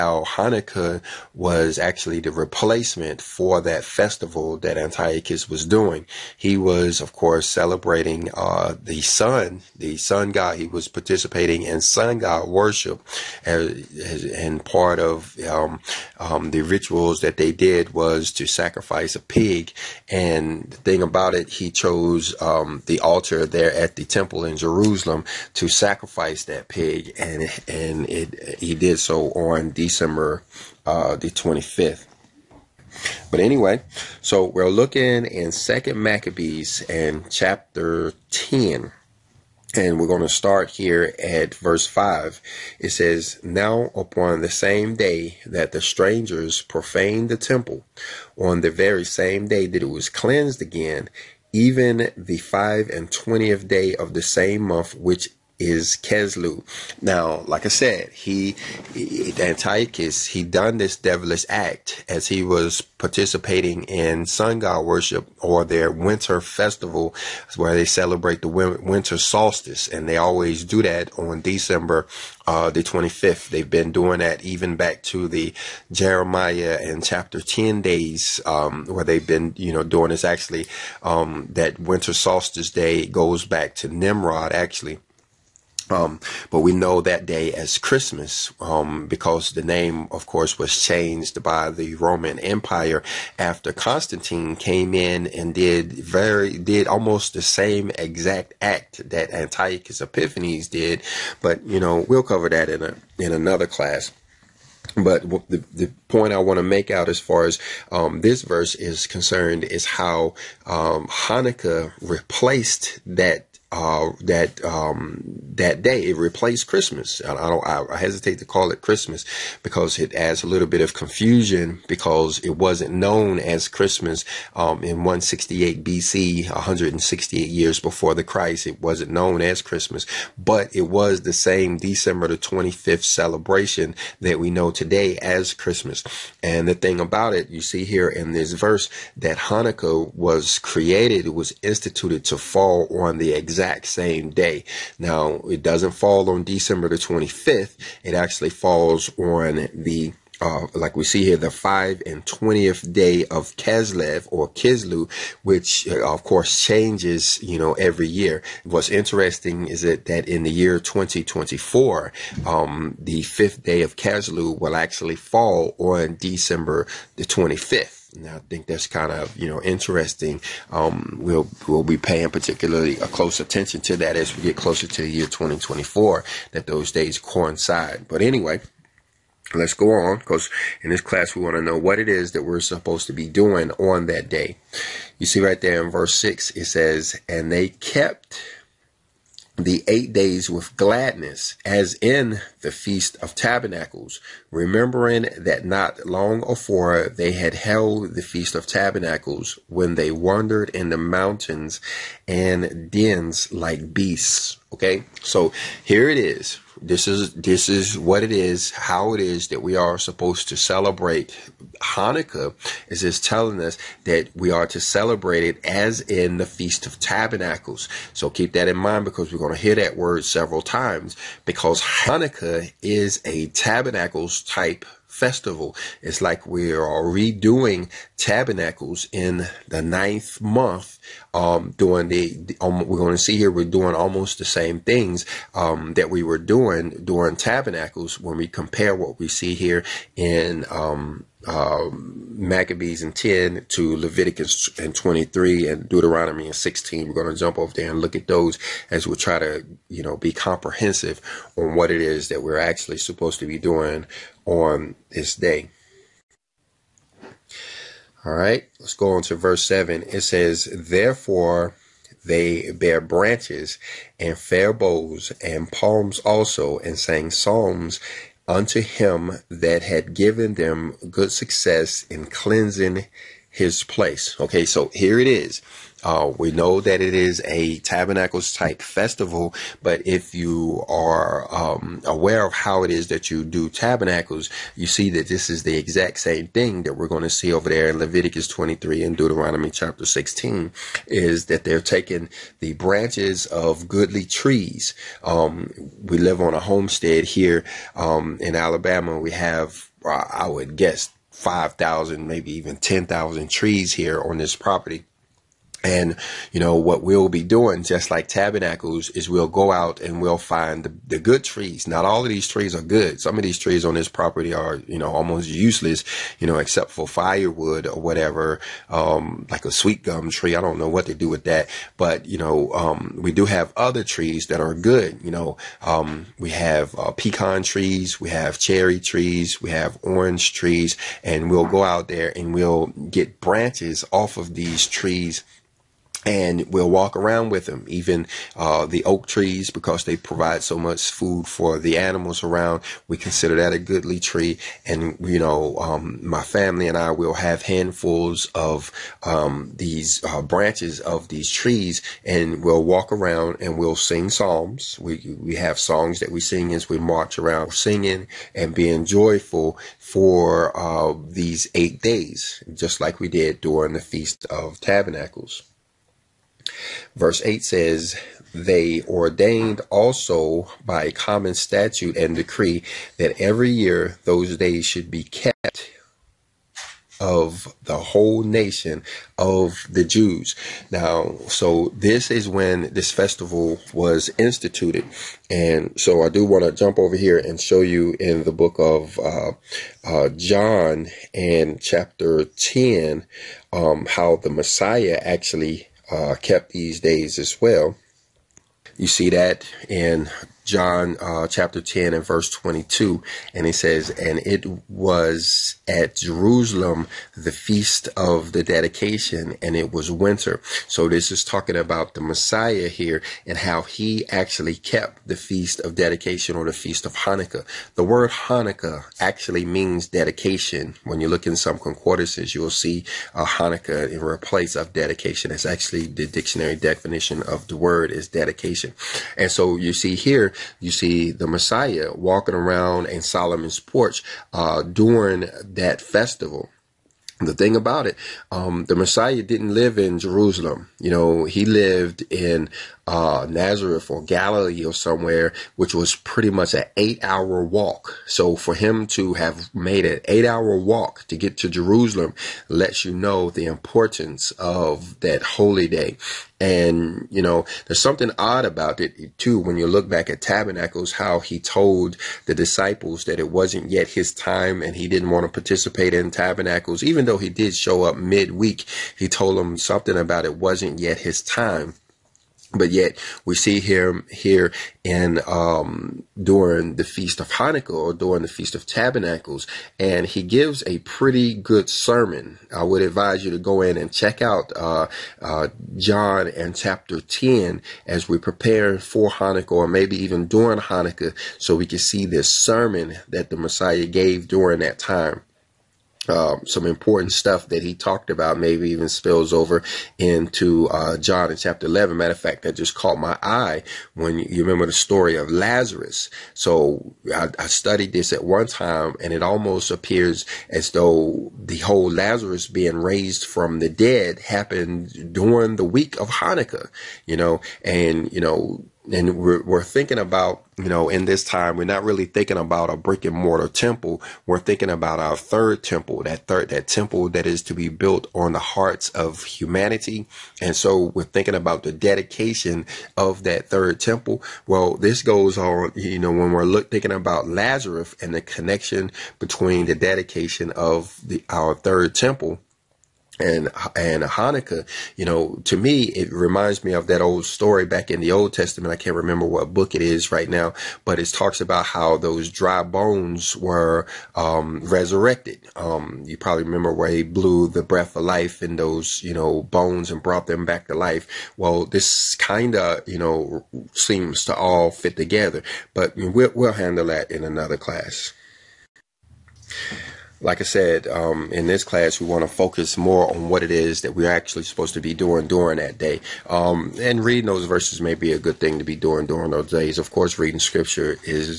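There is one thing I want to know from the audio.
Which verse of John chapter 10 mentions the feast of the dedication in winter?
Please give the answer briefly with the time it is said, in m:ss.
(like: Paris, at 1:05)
Verse 22, at 6:42.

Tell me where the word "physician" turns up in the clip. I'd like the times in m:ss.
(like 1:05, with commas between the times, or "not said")
not said.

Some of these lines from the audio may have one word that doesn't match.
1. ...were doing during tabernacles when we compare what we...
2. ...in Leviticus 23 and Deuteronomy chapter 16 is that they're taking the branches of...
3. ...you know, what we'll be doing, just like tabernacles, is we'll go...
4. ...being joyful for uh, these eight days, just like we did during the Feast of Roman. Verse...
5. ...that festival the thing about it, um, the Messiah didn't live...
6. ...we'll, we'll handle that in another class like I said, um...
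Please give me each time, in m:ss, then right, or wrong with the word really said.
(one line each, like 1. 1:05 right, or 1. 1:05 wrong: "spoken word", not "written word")
1. 3:56 right
2. 4:47 right
3. 5:06 right
4. 5:58 wrong: "Tabernacles", not "Roman"
5. 7:15 right
6. 9:26 right.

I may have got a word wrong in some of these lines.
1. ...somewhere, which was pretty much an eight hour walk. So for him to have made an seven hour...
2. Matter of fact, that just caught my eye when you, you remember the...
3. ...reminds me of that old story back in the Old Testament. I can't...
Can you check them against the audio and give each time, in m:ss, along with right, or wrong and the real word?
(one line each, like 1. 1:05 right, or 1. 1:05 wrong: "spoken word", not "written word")
1. 7:24 wrong: "eight", not "seven"
2. 8:22 right
3. 9:06 right.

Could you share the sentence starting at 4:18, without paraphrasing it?
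All right, let's go on to verse 7.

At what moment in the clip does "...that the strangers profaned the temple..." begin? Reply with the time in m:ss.
0:45.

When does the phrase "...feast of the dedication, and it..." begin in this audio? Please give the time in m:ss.
6:47.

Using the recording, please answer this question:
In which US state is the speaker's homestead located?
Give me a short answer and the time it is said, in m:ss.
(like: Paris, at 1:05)
Alabama, at 4:58.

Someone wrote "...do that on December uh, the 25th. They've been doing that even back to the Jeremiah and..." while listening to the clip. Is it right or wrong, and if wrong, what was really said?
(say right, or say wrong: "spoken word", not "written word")
right.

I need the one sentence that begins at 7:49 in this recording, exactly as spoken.
He told them something about it wasn't yet his time.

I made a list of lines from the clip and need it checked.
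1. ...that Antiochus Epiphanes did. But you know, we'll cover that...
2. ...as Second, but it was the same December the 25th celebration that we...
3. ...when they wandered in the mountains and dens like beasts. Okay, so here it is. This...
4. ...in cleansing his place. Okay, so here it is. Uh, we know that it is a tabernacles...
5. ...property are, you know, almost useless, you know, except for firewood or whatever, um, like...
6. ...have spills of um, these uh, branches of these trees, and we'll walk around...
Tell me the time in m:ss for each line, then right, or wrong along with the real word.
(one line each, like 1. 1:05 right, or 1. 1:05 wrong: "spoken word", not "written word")
1. 1:39 right
2. 2:09 wrong: "Christmas", not "Second"
3. 3:19 right
4. 4:32 right
5. 5:14 right
6. 5:47 wrong: "handfuls", not "spills".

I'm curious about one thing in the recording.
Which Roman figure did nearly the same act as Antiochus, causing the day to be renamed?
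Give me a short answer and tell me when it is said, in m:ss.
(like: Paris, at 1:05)
Constantine, at 1:33.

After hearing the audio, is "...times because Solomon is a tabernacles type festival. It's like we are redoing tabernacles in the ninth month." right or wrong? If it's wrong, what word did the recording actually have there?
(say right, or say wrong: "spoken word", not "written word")
wrong: "Hanukkah", not "Solomon".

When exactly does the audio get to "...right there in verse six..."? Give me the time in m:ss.
3:05.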